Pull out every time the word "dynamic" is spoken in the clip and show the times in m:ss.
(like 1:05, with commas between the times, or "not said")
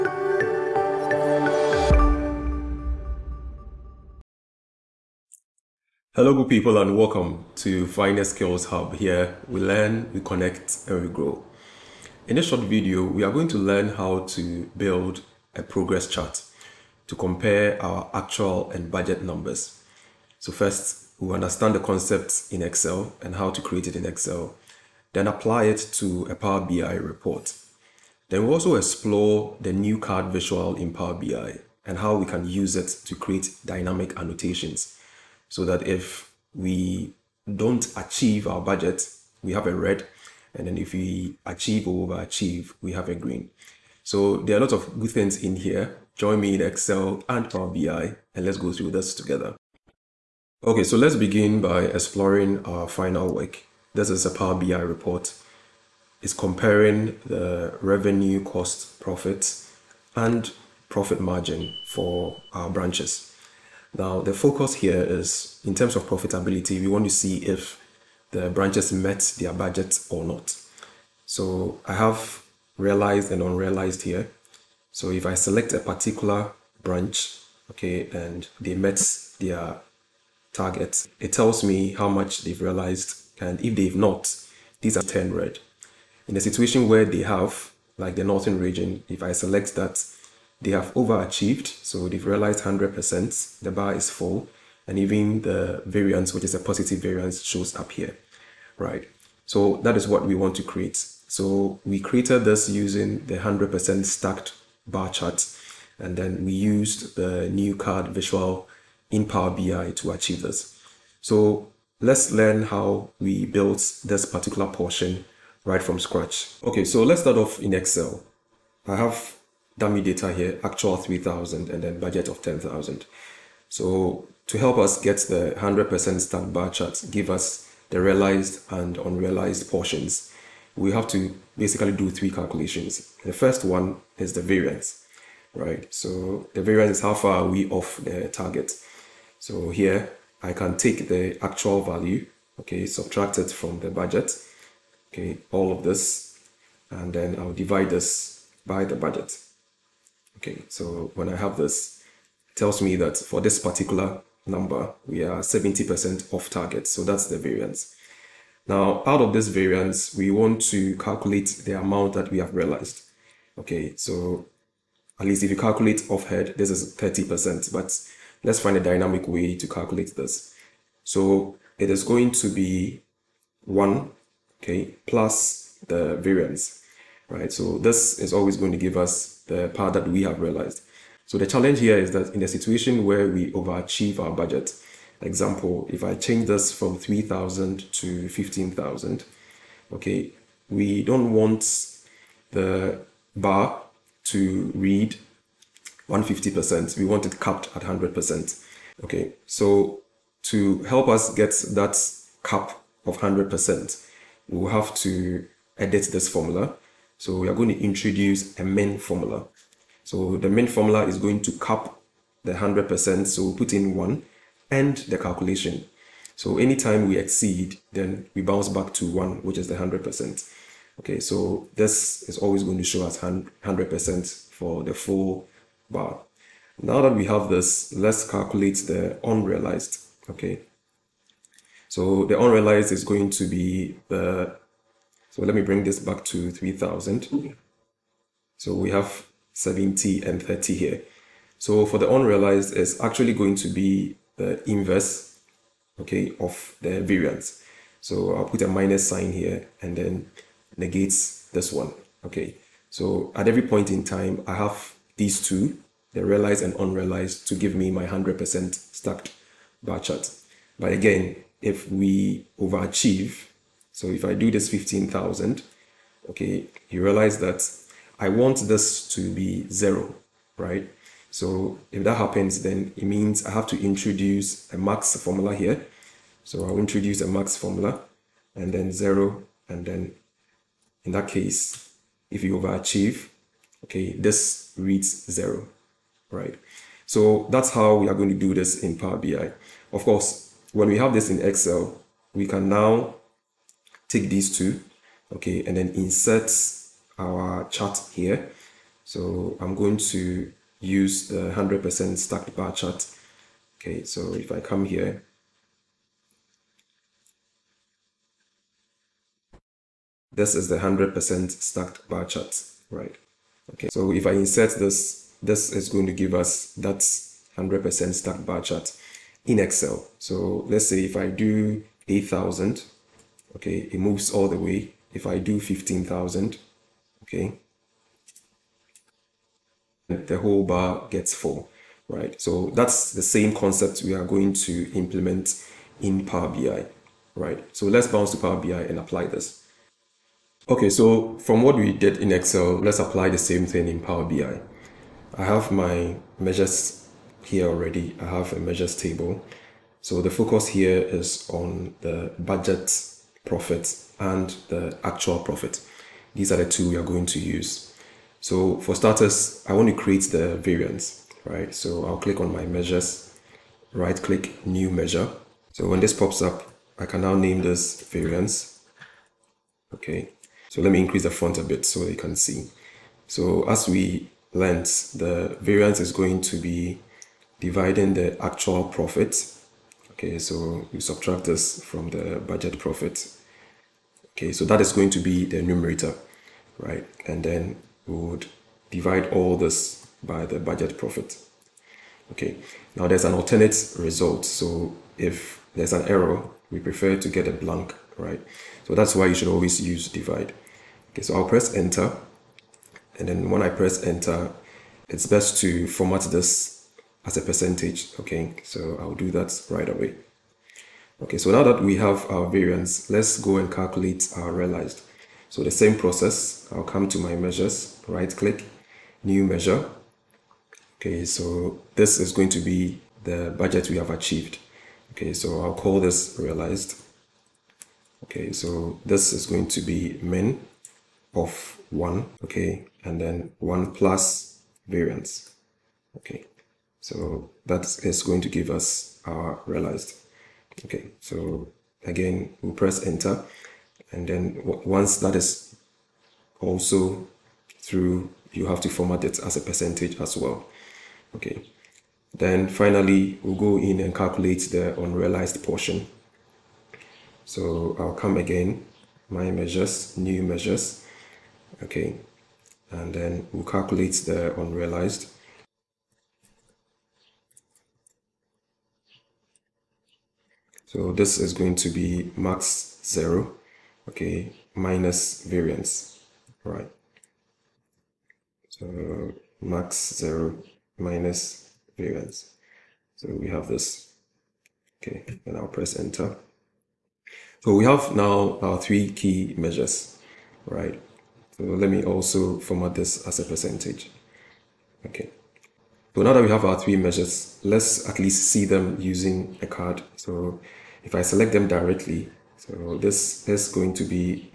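0:33, 2:48.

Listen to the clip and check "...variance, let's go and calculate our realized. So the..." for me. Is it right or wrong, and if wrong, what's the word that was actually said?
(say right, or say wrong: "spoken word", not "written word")
right.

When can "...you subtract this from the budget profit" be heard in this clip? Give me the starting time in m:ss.
6:20.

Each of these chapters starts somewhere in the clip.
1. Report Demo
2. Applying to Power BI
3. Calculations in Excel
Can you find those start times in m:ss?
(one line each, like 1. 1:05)
1. 0:50
2. 5:40
3. 1:57.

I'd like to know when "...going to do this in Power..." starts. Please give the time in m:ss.
4:48.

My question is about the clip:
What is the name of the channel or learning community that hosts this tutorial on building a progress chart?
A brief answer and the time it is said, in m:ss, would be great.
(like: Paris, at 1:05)
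Finex Skills Hub, at 0:07.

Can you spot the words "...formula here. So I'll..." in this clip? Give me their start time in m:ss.
4:35.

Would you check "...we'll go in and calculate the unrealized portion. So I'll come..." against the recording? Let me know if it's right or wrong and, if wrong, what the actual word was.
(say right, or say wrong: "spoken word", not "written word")
right.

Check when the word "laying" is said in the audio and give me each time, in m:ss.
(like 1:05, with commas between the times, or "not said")
not said.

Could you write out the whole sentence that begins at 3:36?
So anytime we exceed, then we bounce back to one, which is the 100%.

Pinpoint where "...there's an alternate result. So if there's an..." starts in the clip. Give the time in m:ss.
6:33.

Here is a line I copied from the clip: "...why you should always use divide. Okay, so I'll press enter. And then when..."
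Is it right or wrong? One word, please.
right.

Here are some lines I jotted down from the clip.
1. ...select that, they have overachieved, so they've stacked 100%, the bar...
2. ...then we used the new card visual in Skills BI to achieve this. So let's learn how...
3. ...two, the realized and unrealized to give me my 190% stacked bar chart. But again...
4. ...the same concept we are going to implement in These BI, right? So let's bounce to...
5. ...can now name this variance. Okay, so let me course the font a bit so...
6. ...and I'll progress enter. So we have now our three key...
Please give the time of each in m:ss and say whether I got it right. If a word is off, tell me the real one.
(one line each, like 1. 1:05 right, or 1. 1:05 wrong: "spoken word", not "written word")
1. 1:29 wrong: "realized", not "stacked"
2. 1:46 wrong: "Power", not "Skills"
3. 4:15 wrong: "100", not "190"
4. 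5:33 wrong: "Power", not "These"
5. 6:07 wrong: "increase", not "course"
6. 8:05 wrong: "press", not "progress".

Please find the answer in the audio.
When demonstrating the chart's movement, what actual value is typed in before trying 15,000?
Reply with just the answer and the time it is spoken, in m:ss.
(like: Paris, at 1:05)
8,000, at 5:22.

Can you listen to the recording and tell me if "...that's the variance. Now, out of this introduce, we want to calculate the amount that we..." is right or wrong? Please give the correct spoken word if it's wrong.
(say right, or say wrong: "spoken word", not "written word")
wrong: "variance", not "introduce".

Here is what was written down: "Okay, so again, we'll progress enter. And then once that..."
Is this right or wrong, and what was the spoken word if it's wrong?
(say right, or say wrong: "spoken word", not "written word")
wrong: "press", not "progress".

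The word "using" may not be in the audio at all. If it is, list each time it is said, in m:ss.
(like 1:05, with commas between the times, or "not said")
1:42, 8:19.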